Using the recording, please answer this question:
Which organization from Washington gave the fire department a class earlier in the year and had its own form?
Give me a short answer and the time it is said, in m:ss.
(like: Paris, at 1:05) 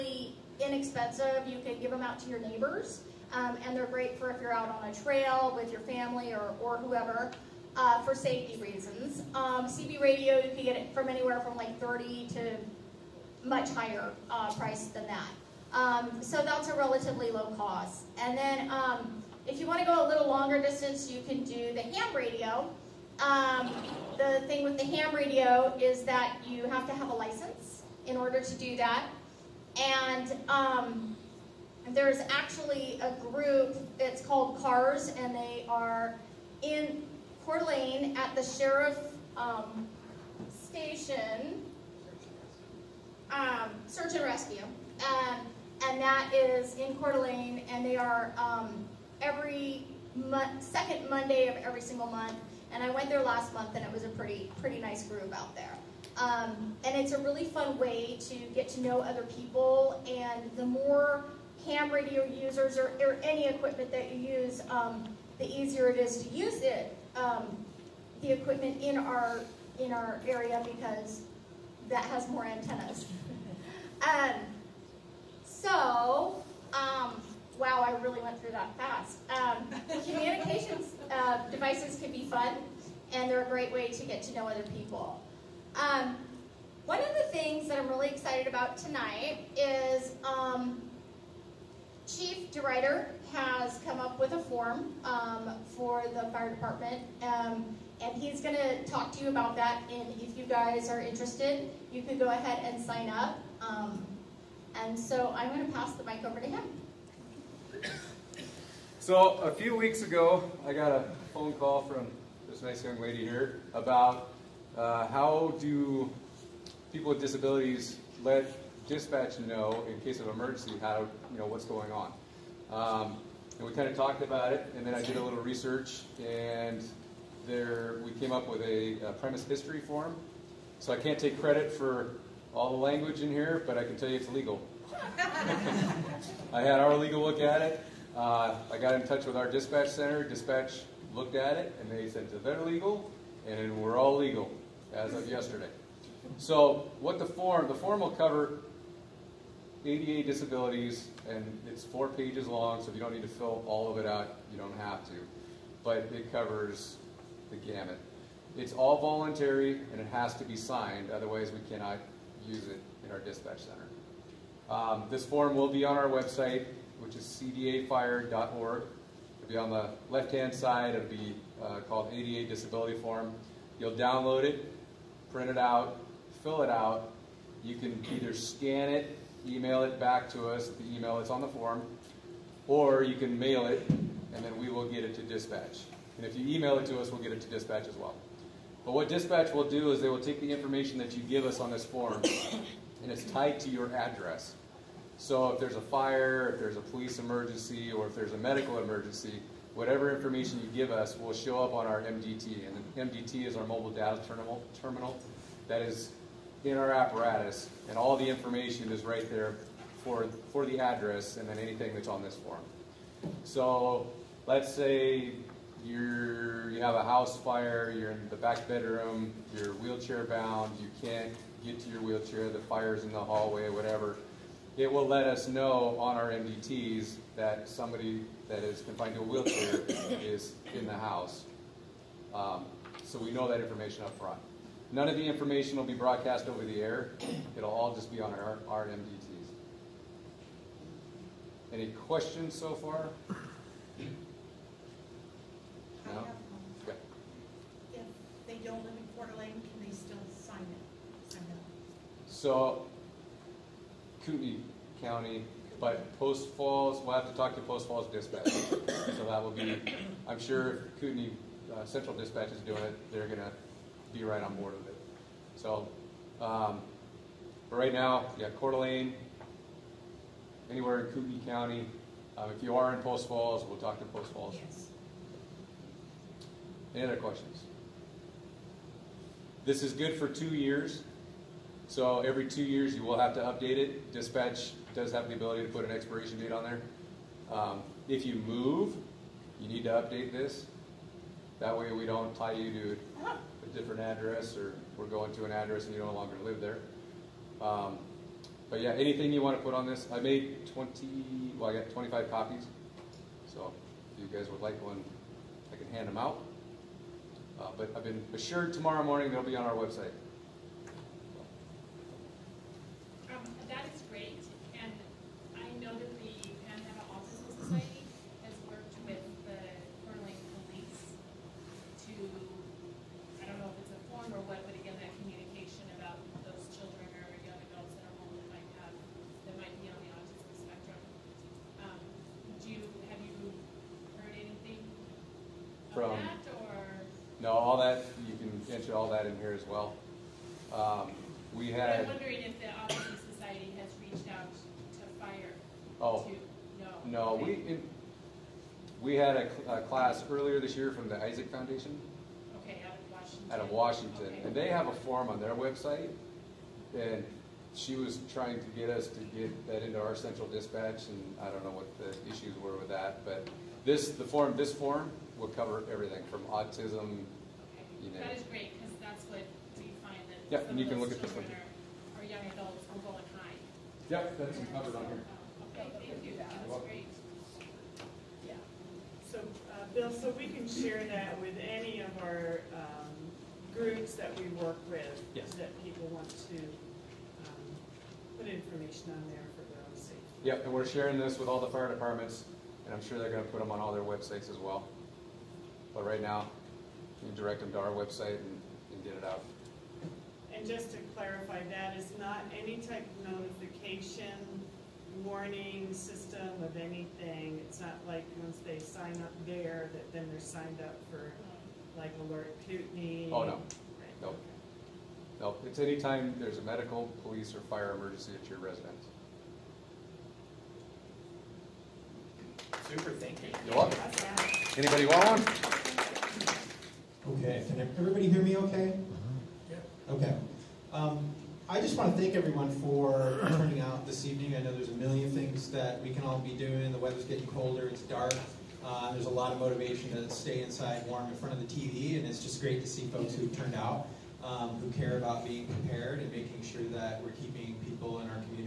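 Isaac Foundation, at 5:51.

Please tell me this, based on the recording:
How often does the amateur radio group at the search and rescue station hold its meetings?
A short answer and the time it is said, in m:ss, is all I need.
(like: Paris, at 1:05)
Every second Monday, at 0:49.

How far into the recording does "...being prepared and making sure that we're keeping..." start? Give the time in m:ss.
7:25.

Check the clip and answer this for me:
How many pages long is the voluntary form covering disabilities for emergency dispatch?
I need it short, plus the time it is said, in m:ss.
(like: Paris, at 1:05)
4, at 2:31.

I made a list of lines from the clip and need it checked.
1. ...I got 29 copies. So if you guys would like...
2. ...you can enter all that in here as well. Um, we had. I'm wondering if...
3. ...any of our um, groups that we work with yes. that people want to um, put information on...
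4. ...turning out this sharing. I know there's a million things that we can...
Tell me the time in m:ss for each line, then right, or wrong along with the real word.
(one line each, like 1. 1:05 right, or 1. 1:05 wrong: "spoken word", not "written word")
1. 5:01 wrong: "25", not "29"
2. 5:38 right
3. 6:21 right
4. 7:13 wrong: "evening", not "sharing".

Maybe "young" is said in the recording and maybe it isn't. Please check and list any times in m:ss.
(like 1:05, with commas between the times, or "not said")
1:52, 6:12.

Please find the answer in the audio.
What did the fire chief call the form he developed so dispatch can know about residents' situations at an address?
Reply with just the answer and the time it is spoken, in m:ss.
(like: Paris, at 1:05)
Premise history form, at 2:09.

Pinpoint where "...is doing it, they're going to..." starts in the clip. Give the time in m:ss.
4:22.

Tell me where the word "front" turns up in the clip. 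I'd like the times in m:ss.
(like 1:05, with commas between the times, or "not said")
3:54, 7:21.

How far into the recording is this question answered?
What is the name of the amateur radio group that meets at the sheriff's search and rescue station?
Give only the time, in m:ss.
0:34.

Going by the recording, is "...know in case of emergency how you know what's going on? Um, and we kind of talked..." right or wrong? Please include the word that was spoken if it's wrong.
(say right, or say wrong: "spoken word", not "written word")
right.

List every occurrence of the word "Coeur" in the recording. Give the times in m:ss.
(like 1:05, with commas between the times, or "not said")
0:37, 0:46, 4:09, 4:28.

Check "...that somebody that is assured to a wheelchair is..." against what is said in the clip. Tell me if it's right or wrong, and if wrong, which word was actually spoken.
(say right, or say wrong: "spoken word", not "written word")
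wrong: "confined", not "assured".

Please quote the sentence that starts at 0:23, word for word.
Um, the thing with the ham radio is that you have to have a license in order to do that.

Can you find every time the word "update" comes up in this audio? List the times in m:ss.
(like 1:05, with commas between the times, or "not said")
4:43, 4:49.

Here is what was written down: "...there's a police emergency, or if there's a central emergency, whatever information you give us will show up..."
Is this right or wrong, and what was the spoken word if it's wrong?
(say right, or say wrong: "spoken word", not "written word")
wrong: "medical", not "central".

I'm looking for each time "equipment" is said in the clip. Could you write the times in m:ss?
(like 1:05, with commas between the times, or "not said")
1:03, 1:08.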